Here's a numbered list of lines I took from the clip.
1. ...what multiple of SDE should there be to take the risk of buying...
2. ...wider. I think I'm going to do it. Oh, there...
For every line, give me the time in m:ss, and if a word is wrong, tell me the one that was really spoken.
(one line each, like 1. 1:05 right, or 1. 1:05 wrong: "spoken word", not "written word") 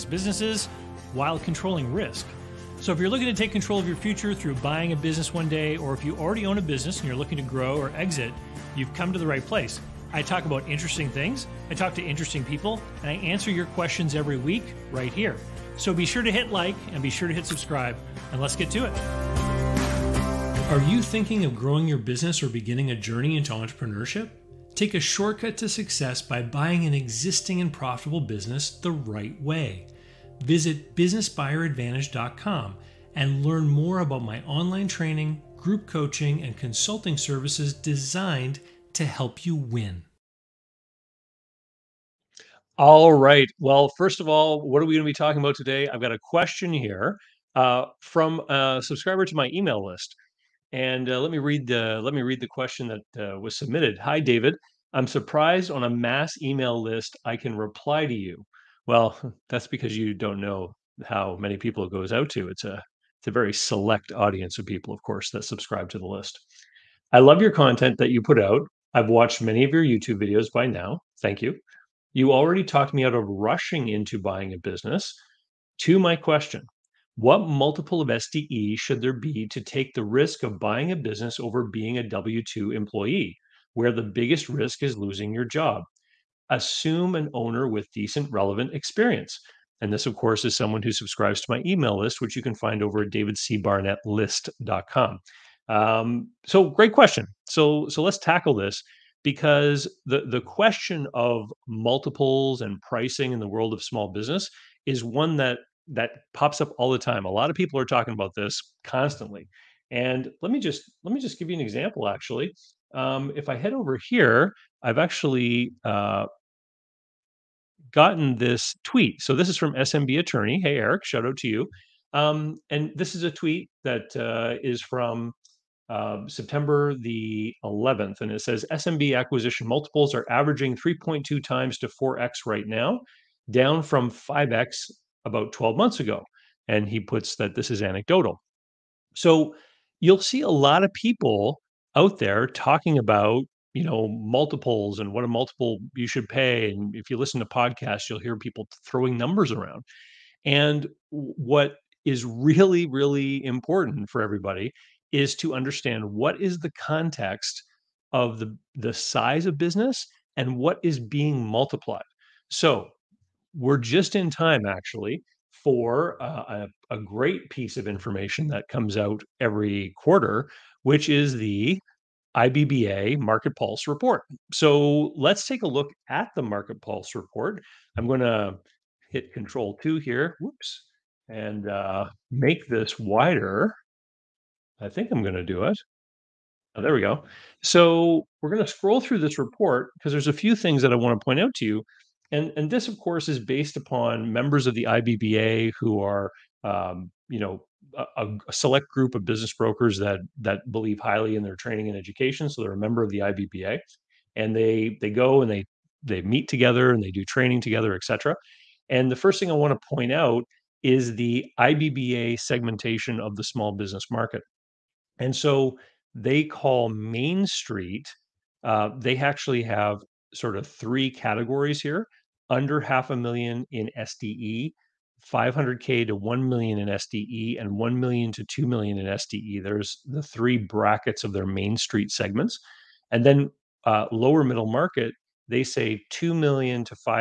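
1. 1:17 right
2. 3:02 right.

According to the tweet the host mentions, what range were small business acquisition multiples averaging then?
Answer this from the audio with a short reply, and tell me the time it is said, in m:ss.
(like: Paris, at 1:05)
3.2 times to 4x, at 2:10.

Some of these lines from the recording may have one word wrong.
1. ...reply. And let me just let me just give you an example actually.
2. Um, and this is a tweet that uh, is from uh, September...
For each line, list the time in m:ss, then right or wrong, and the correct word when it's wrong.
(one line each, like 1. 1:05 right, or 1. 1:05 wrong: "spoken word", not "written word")
1. 1:48 wrong: "constantly", not "reply"
2. 2:02 right.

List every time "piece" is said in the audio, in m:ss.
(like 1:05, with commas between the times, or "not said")
2:47.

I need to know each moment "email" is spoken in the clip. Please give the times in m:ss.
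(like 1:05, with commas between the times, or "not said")
0:49, 0:56, 1:31.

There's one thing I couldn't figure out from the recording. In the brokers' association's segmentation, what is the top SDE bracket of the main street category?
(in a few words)
1 million to 2 million.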